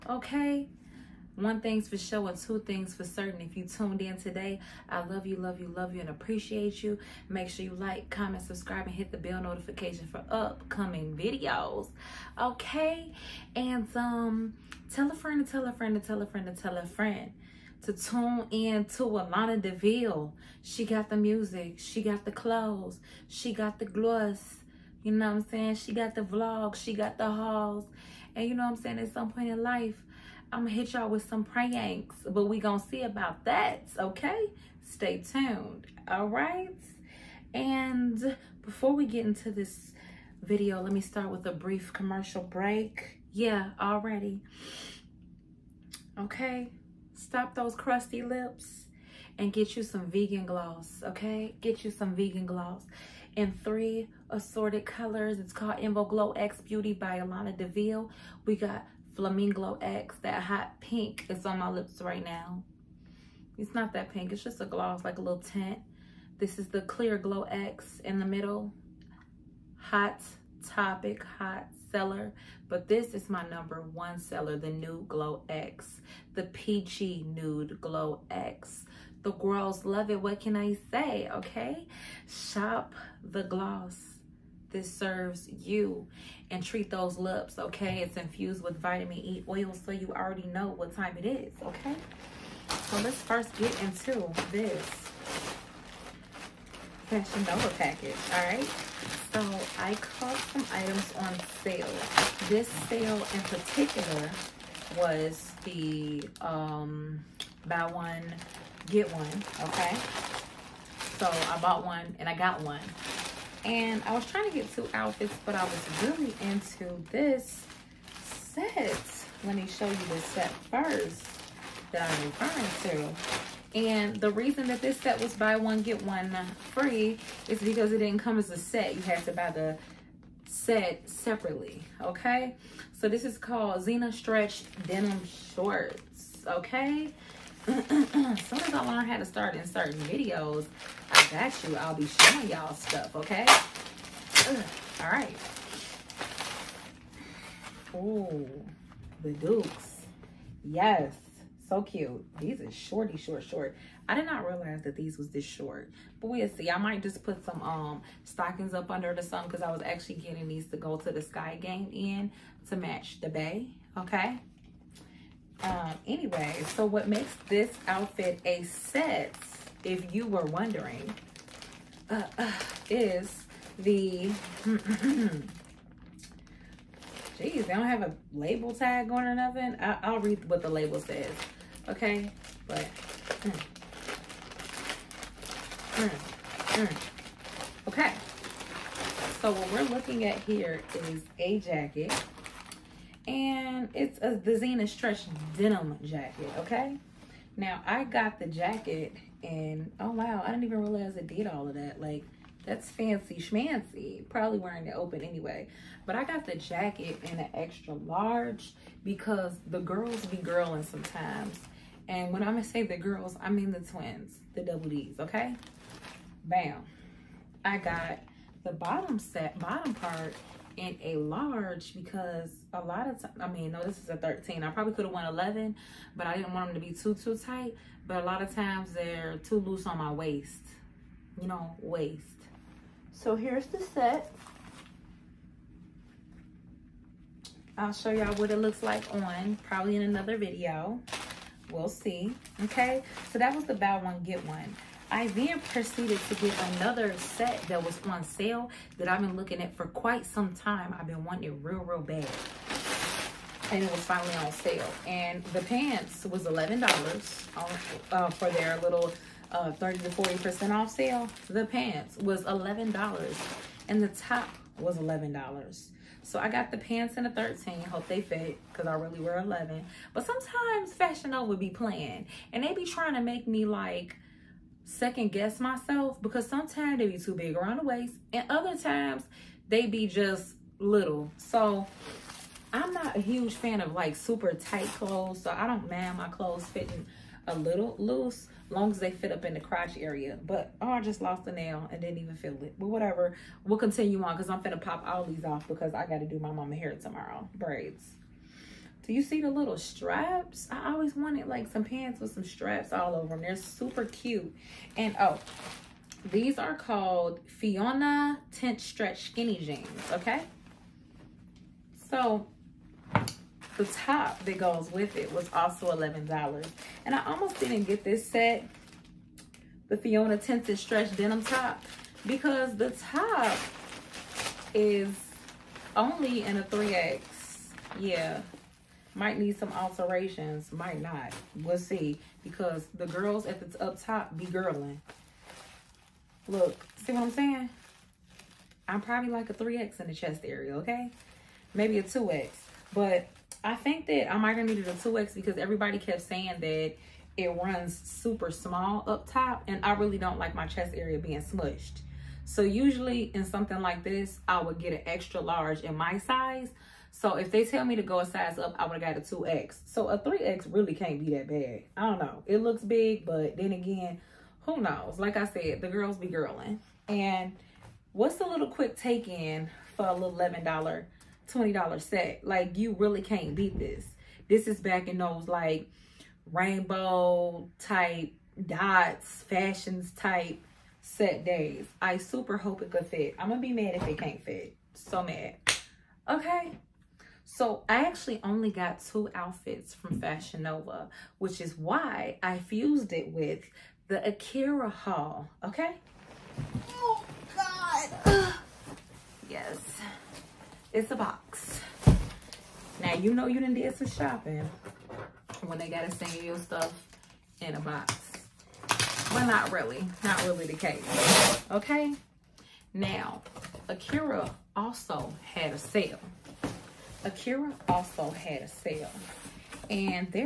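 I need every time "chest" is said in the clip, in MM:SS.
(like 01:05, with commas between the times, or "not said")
05:40, 05:50.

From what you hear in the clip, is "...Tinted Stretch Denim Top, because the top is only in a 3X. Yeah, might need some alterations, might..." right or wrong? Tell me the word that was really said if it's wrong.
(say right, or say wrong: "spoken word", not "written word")
right.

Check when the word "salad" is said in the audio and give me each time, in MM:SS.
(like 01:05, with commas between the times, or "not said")
not said.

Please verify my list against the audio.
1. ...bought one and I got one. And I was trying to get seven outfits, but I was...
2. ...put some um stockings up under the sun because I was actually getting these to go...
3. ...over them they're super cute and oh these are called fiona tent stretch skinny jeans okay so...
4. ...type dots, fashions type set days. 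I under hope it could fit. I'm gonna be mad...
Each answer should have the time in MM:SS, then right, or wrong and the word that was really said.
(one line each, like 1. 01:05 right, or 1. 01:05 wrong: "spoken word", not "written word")
1. 01:51 wrong: "two", not "seven"
2. 02:37 right
3. 05:03 right
4. 06:17 wrong: "super", not "under".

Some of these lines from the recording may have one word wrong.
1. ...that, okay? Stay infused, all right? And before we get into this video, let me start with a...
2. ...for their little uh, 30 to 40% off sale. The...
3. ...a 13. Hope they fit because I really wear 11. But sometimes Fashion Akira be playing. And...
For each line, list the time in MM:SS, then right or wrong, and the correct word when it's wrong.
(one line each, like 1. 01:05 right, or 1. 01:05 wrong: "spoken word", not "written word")
1. 00:33 wrong: "tuned", not "infused"
2. 04:18 right
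3. 04:27 wrong: "Nova", not "Akira".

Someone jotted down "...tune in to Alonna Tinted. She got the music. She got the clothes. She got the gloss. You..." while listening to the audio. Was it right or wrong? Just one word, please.
wrong.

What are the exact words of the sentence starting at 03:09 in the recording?
So what we're looking at here is a jacket and it's a, the Zena stretch denim jacket, okay?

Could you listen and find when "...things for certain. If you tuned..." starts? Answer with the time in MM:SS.
00:02.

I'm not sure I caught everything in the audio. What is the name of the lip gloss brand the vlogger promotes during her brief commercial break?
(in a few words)
Invo Glow X Beauty.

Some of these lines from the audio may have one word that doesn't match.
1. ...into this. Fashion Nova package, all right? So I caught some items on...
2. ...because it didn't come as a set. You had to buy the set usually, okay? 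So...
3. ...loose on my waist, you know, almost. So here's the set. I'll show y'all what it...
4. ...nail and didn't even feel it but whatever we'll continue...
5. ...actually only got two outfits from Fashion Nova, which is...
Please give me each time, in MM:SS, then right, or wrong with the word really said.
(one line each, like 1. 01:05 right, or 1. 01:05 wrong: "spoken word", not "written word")
1. 01:33 right
2. 02:07 wrong: "separately", not "usually"
3. 03:49 wrong: "waist", not "almost"
4. 04:51 right
5. 06:28 right.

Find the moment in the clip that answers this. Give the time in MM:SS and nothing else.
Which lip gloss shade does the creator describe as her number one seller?
01:16.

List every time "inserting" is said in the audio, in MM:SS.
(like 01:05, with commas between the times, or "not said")
02:19.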